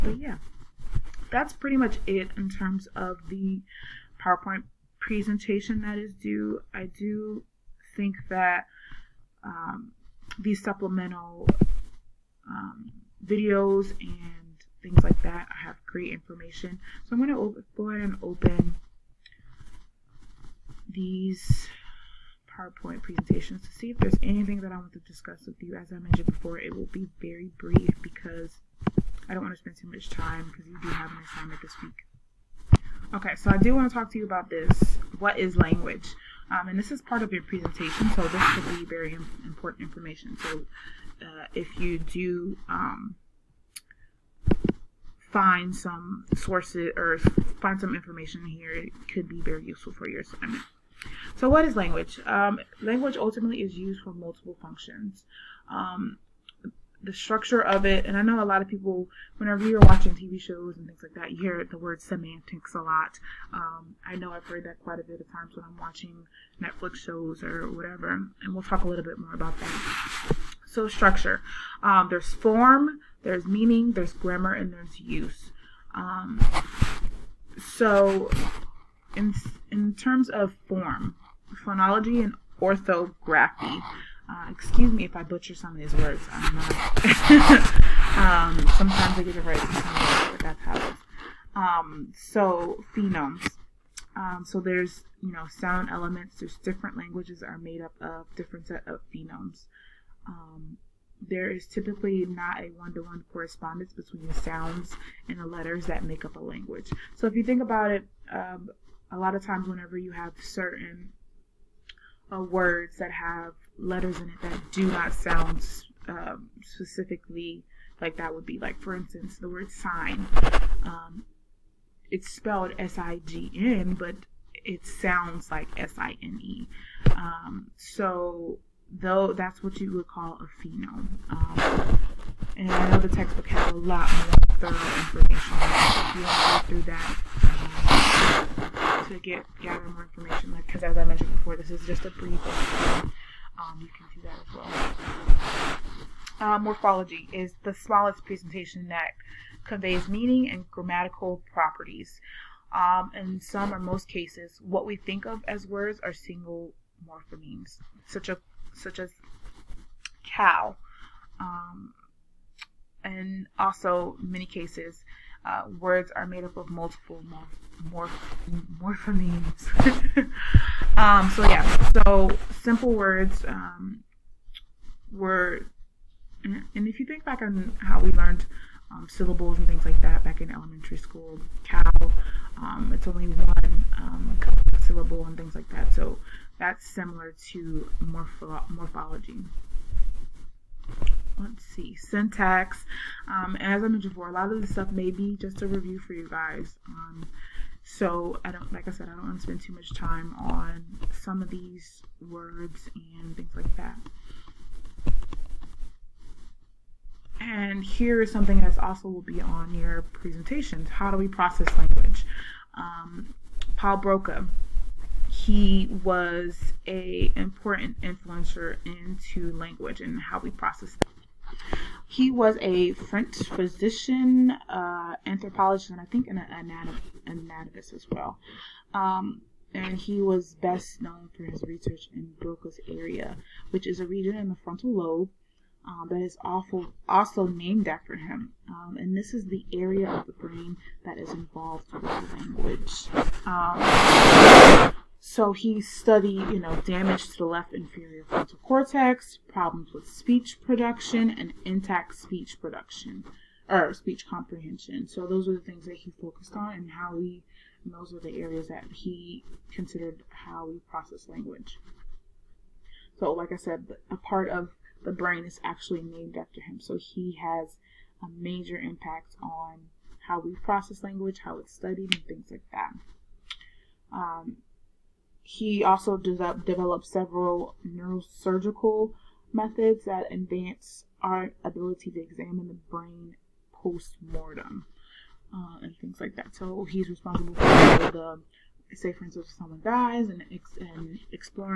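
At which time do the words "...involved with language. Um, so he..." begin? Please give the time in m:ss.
4:01.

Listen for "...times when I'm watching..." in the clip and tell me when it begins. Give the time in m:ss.
1:05.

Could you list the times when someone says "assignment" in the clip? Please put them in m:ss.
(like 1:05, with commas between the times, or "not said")
0:31, 0:50.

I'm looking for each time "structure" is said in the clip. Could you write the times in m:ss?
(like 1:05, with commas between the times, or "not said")
0:57, 1:10.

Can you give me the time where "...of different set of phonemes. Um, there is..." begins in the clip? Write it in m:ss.
1:37.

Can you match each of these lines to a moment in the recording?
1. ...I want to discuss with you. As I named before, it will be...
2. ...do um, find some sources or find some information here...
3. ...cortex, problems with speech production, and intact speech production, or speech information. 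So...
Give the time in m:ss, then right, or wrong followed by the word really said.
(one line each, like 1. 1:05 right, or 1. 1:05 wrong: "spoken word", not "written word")
1. 0:24 wrong: "mentioned", not "named"
2. 0:41 right
3. 4:08 wrong: "comprehension", not "information".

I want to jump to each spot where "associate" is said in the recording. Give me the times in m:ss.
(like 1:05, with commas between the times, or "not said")
not said.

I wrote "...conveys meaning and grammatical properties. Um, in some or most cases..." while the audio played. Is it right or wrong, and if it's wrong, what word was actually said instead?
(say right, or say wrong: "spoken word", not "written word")
right.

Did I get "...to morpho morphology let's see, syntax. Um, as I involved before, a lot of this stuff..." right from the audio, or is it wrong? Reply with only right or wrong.
wrong.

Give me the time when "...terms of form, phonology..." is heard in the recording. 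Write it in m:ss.
1:19.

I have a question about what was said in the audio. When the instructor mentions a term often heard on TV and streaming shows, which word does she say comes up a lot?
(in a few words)
semantics.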